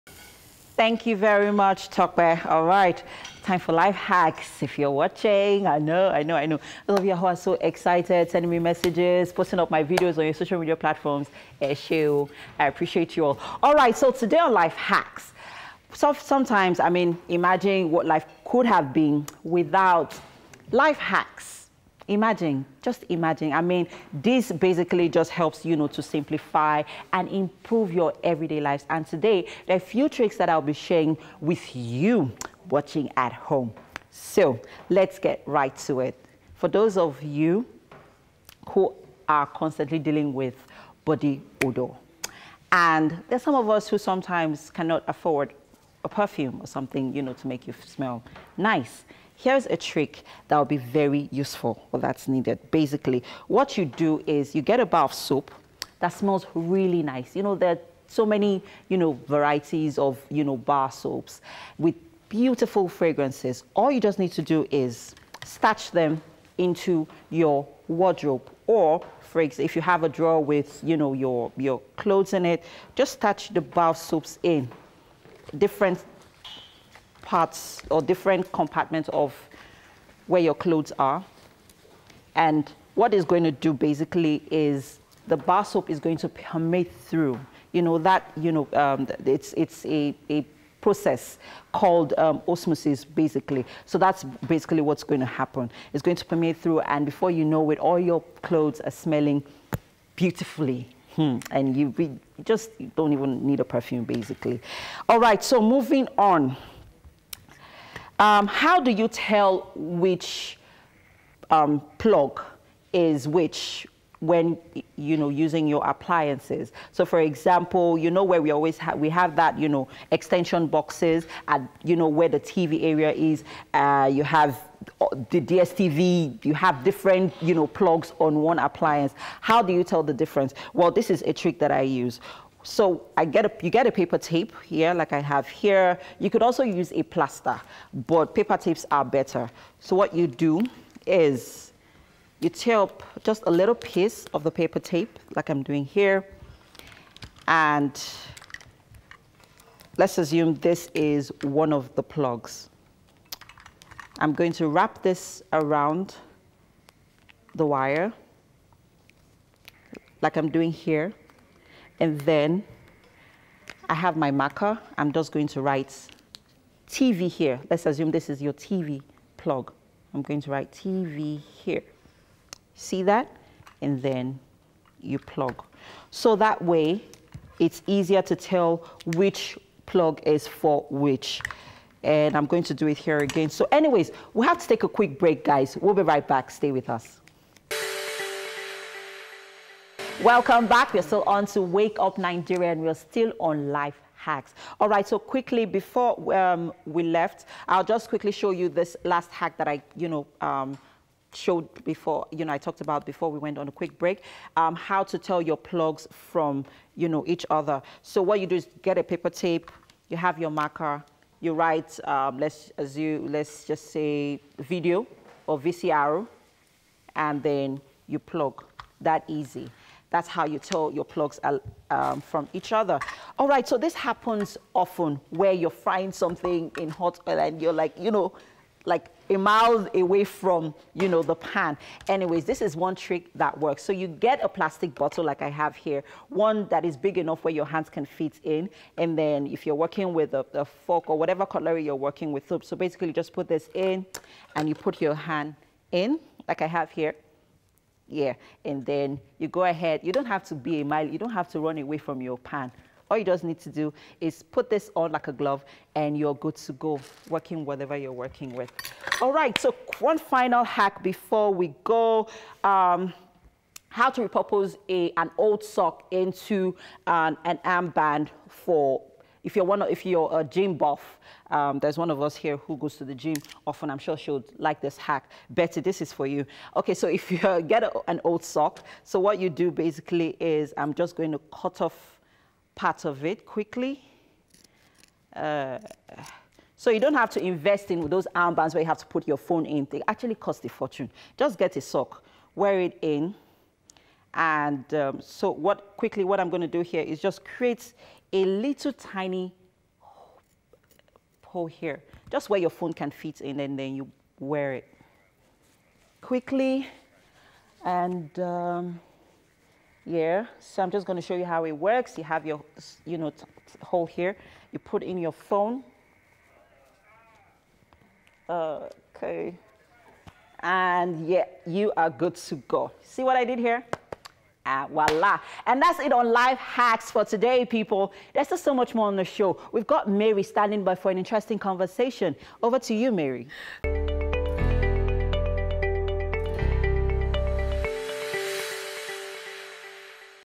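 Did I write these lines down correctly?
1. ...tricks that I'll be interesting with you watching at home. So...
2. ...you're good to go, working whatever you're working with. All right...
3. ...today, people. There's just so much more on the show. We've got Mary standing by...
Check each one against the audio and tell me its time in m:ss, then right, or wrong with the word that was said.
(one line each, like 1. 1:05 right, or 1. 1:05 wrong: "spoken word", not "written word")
1. 0:30 wrong: "sharing", not "interesting"
2. 4:16 right
3. 5:27 right.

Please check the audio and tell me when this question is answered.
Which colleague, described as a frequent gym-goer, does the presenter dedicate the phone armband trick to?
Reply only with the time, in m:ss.
4:35.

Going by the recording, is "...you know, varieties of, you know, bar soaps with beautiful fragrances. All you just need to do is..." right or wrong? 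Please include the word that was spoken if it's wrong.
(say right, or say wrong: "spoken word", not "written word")
right.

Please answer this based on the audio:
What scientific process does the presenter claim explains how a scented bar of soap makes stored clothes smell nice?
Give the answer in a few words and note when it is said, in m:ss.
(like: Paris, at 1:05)
osmosis, at 1:32.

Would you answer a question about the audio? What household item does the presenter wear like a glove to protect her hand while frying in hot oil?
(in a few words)
plastic bottle.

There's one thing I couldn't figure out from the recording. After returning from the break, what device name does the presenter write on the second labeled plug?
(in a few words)
VCR.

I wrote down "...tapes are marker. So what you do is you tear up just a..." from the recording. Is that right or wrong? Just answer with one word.
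wrong.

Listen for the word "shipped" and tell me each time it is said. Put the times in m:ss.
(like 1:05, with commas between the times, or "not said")
not said.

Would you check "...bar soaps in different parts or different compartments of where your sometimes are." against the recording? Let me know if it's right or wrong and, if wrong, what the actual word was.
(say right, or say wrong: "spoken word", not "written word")
wrong: "clothes", not "sometimes".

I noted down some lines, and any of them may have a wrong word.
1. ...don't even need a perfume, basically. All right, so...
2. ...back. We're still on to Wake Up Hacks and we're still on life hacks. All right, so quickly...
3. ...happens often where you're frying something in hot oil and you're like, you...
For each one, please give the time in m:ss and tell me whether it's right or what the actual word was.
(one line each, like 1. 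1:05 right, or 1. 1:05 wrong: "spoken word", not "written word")
1. 1:42 right
2. 3:10 wrong: "Nigeria", not "Hacks"
3. 3:43 right.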